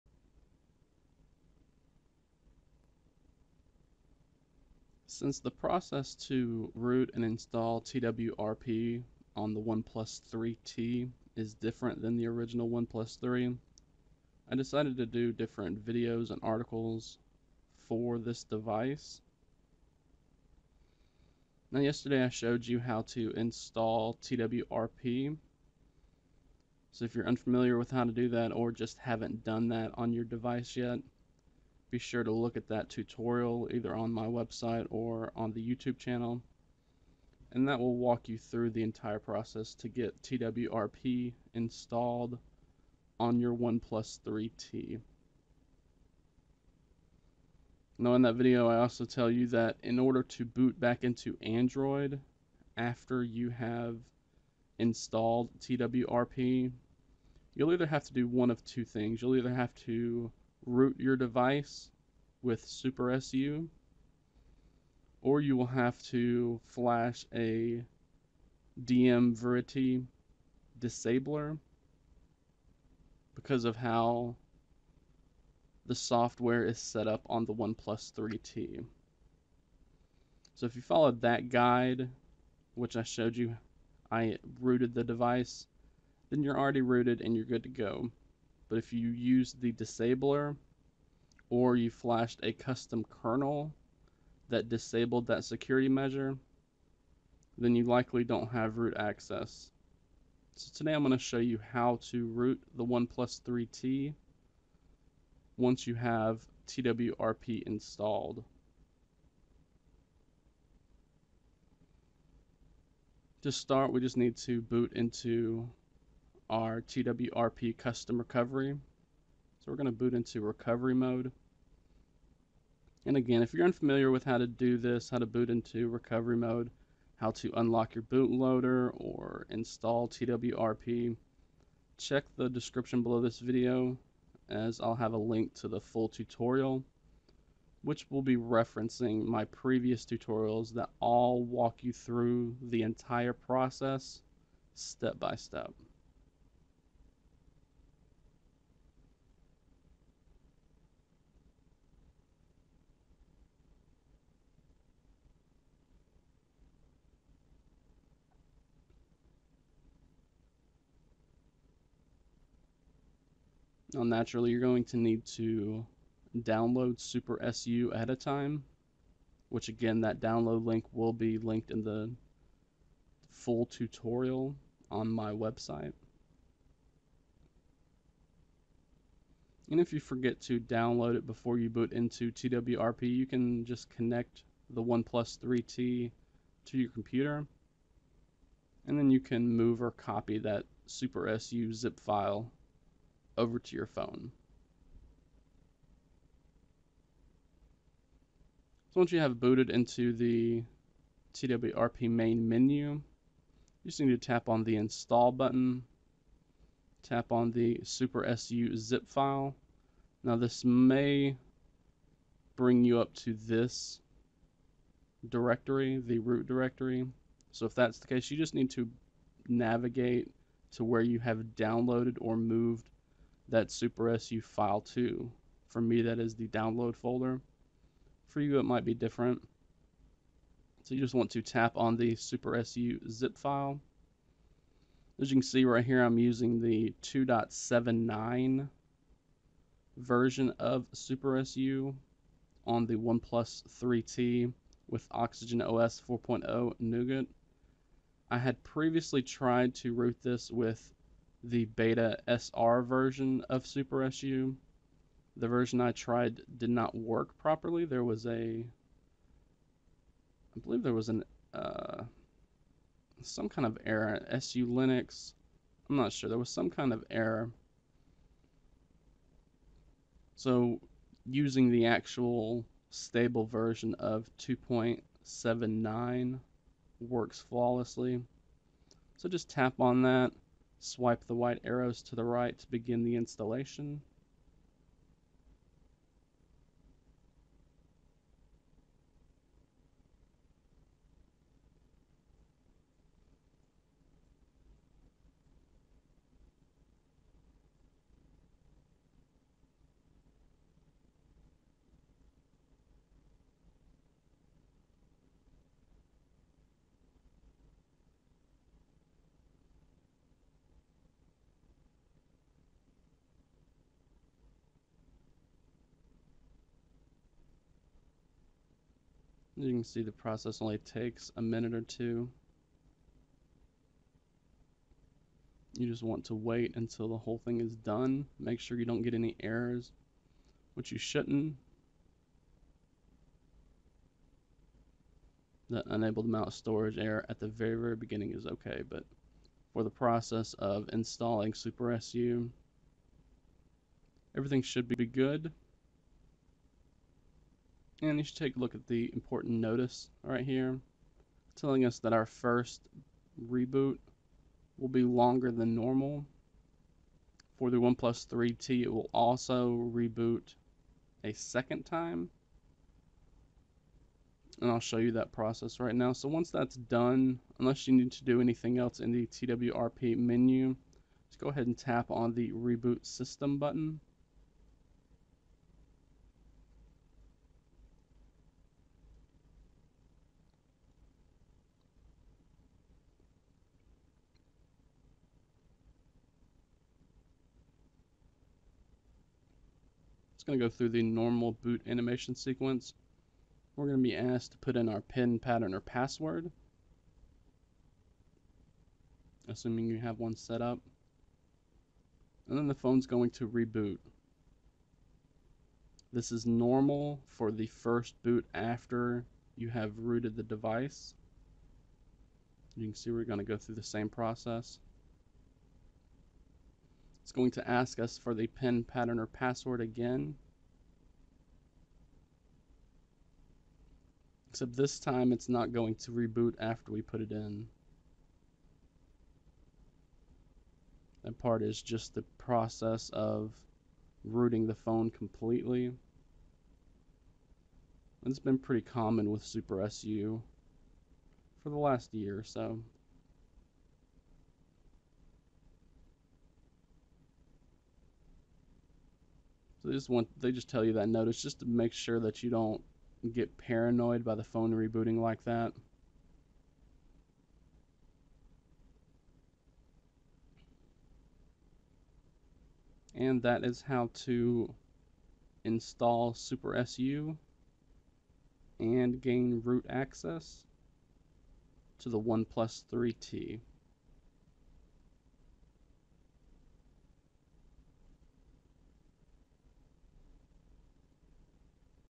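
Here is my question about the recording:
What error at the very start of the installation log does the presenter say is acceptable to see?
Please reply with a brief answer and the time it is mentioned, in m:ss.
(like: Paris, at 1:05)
mount storage error, at 5:36.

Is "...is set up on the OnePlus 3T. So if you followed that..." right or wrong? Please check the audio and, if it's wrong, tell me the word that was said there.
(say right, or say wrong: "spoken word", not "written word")
right.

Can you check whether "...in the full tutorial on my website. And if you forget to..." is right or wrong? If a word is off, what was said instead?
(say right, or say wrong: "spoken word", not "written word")
right.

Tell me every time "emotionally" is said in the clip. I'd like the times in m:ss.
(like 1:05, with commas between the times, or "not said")
not said.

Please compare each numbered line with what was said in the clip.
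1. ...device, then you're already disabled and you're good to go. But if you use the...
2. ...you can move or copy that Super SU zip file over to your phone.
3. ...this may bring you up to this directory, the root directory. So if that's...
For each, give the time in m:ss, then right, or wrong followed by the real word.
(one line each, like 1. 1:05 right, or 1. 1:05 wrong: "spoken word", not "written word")
1. 1:25 wrong: "rooted", not "disabled"
2. 3:09 right
3. 3:30 right.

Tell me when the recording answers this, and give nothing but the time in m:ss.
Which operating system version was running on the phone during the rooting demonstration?
4:05.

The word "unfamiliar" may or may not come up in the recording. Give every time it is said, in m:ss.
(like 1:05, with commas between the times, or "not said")
0:27, 2:03.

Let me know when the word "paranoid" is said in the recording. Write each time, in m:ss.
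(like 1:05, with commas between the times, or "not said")
7:33.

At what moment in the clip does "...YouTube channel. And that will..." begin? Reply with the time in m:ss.
0:35.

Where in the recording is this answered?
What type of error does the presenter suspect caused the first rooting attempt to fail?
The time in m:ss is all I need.
4:24.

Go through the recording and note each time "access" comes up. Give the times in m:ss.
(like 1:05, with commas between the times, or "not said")
1:38, 7:49.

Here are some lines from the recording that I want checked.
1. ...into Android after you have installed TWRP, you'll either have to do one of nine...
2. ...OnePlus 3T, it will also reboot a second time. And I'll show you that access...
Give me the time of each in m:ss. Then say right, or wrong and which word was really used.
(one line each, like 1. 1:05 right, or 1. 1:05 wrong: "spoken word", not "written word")
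1. 0:51 wrong: "two", not "nine"
2. 5:57 wrong: "process", not "access".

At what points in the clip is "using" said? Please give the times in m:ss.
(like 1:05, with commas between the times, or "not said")
3:56, 4:31.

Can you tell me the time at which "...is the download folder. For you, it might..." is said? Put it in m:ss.
3:46.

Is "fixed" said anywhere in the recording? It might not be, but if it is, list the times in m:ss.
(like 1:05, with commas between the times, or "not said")
not said.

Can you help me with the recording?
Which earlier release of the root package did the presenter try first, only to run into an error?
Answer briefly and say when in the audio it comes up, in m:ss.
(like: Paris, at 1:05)
beta SR version, at 4:11.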